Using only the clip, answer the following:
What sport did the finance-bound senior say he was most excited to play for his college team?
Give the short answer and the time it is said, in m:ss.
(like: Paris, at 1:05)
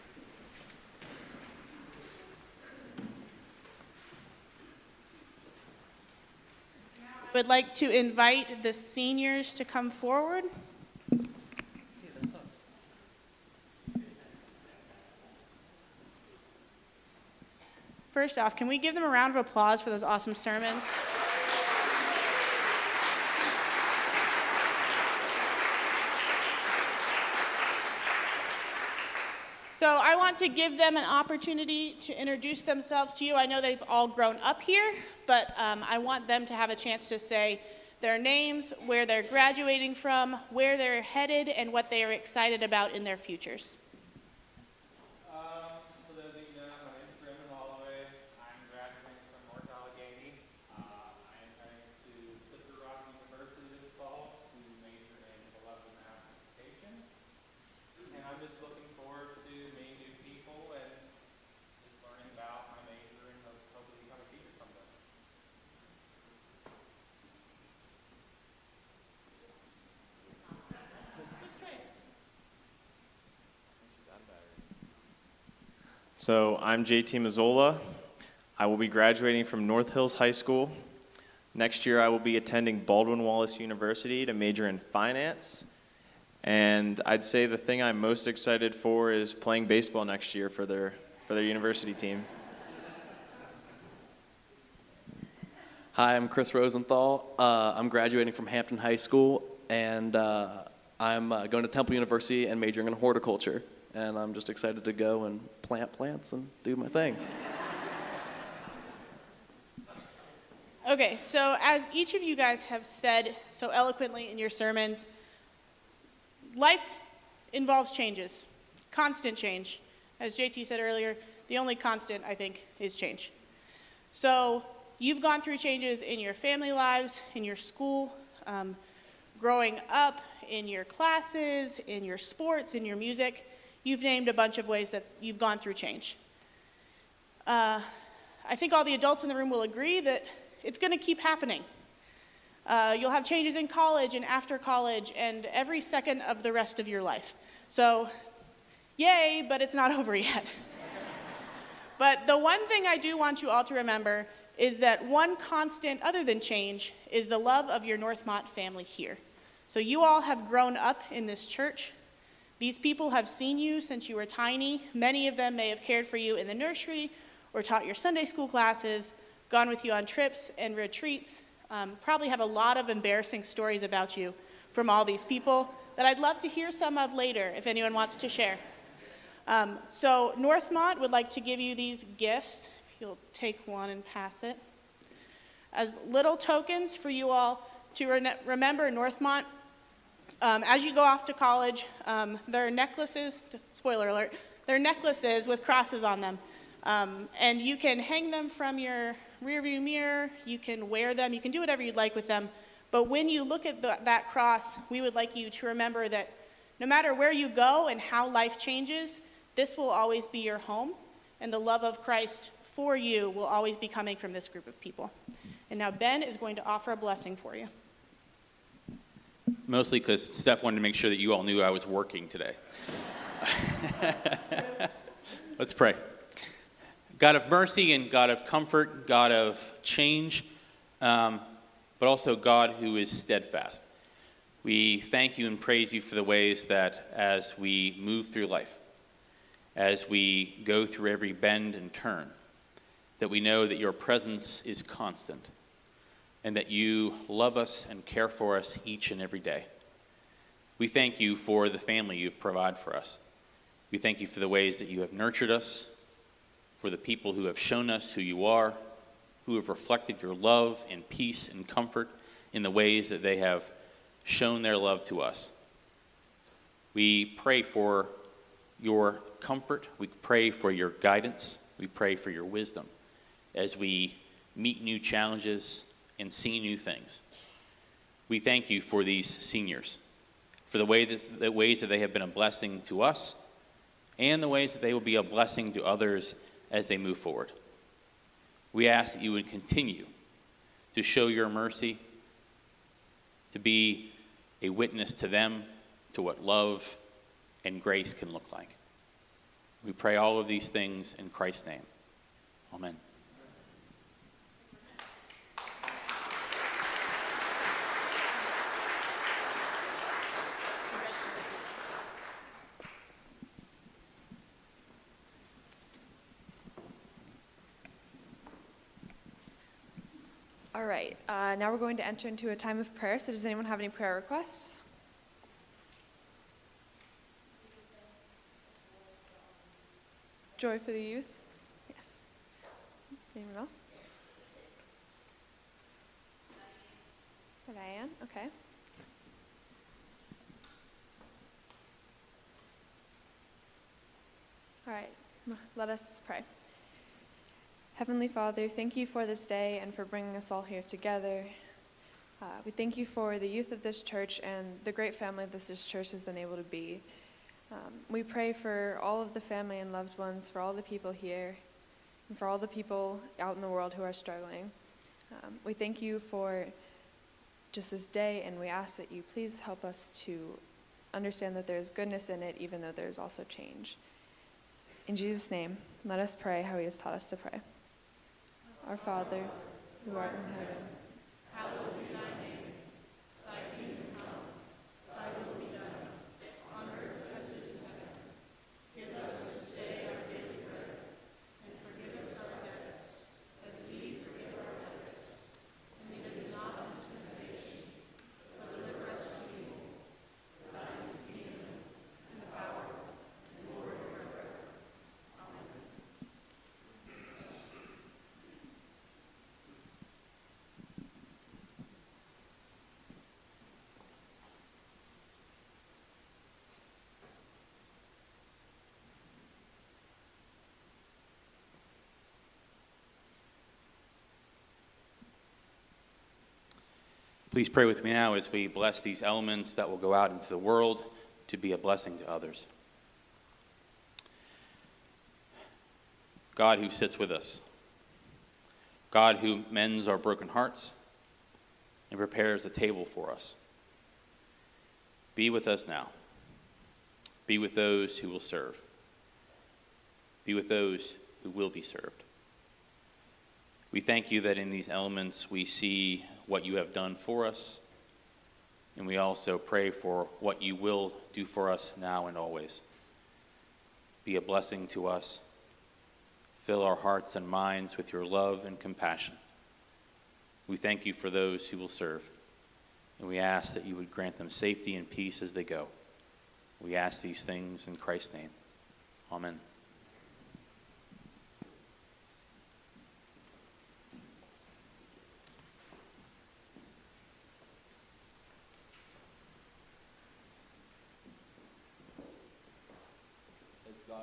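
baseball, at 1:29.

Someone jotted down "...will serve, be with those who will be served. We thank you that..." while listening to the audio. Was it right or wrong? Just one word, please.
right.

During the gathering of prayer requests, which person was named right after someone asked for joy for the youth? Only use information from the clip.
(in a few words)
Diane.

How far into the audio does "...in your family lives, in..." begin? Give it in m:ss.
2:06.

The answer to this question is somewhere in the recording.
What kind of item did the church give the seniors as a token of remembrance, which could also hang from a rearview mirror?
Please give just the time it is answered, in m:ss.
3:14.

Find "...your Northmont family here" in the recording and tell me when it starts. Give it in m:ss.
2:37.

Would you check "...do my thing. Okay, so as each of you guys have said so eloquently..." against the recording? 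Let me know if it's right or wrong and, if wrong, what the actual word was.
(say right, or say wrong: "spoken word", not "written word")
right.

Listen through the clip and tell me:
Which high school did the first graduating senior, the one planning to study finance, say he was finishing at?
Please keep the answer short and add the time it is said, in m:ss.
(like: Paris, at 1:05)
North Hills High School, at 1:19.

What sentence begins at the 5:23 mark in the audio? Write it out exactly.
So, does anyone have any prayer requests?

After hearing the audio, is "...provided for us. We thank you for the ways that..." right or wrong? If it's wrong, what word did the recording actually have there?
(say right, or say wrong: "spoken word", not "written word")
right.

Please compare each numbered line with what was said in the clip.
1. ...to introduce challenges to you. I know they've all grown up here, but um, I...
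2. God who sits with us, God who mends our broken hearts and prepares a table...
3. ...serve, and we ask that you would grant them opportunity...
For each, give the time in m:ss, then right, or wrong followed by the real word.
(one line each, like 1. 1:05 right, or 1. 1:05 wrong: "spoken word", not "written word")
1. 0:31 wrong: "themselves", not "challenges"
2. 7:16 right
3. 7:51 wrong: "safety", not "opportunity".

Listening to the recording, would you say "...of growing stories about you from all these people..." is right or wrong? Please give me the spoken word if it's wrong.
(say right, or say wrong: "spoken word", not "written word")
wrong: "embarrassing", not "growing".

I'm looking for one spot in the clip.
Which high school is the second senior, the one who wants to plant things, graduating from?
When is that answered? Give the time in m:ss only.
1:38.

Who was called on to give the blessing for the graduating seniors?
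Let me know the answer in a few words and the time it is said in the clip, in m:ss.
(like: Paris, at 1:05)
Ben, at 3:35.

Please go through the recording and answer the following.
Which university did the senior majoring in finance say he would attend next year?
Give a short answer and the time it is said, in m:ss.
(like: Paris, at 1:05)
Baldwin Wallace University, at 1:22.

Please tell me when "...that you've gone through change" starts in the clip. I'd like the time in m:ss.
2:14.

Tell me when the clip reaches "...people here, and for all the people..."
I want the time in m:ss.
6:00.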